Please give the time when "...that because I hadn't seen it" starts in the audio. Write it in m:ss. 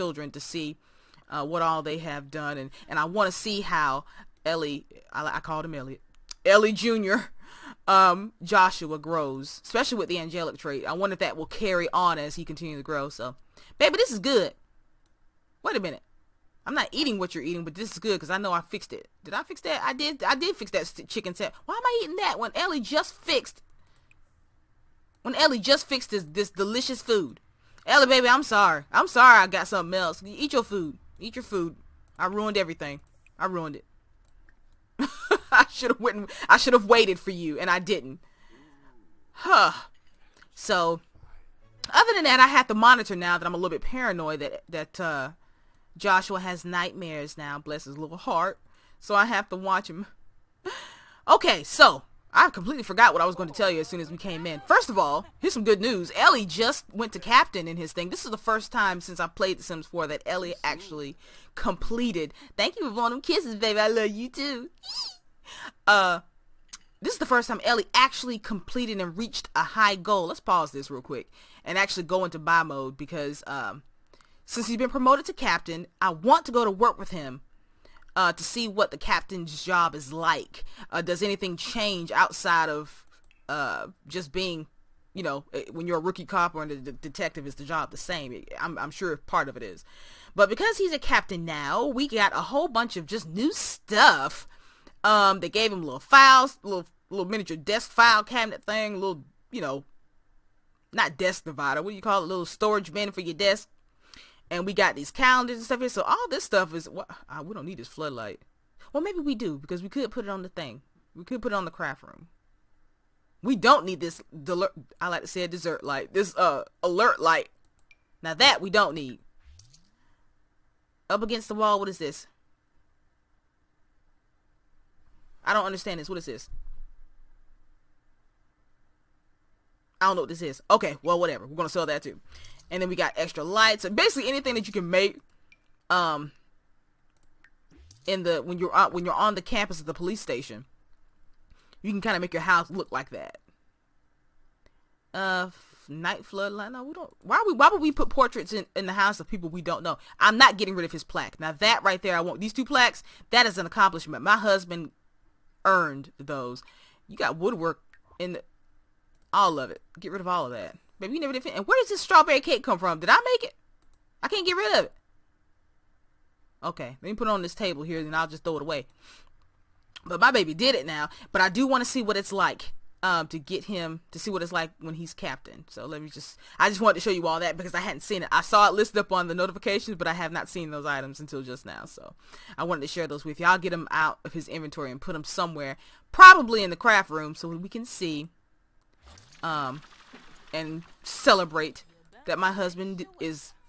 2:57.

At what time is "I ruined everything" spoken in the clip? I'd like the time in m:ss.
0:32.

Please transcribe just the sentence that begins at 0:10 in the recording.
I wonder if that will carry on as he continues to grow.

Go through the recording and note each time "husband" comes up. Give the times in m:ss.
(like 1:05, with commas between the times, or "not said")
2:34, 3:12.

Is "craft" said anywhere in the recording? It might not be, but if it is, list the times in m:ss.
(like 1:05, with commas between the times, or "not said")
1:51, 3:06.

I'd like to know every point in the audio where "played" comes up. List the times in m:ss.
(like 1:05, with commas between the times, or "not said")
0:59.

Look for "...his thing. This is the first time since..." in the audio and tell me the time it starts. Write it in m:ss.
0:57.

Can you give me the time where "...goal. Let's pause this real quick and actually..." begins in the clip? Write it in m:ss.
1:09.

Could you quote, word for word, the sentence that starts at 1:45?
So all this stuff is what well, uh, we don't need this floodlight.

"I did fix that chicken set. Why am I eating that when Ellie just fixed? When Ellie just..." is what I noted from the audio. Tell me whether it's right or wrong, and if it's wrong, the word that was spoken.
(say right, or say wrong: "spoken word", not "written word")
right.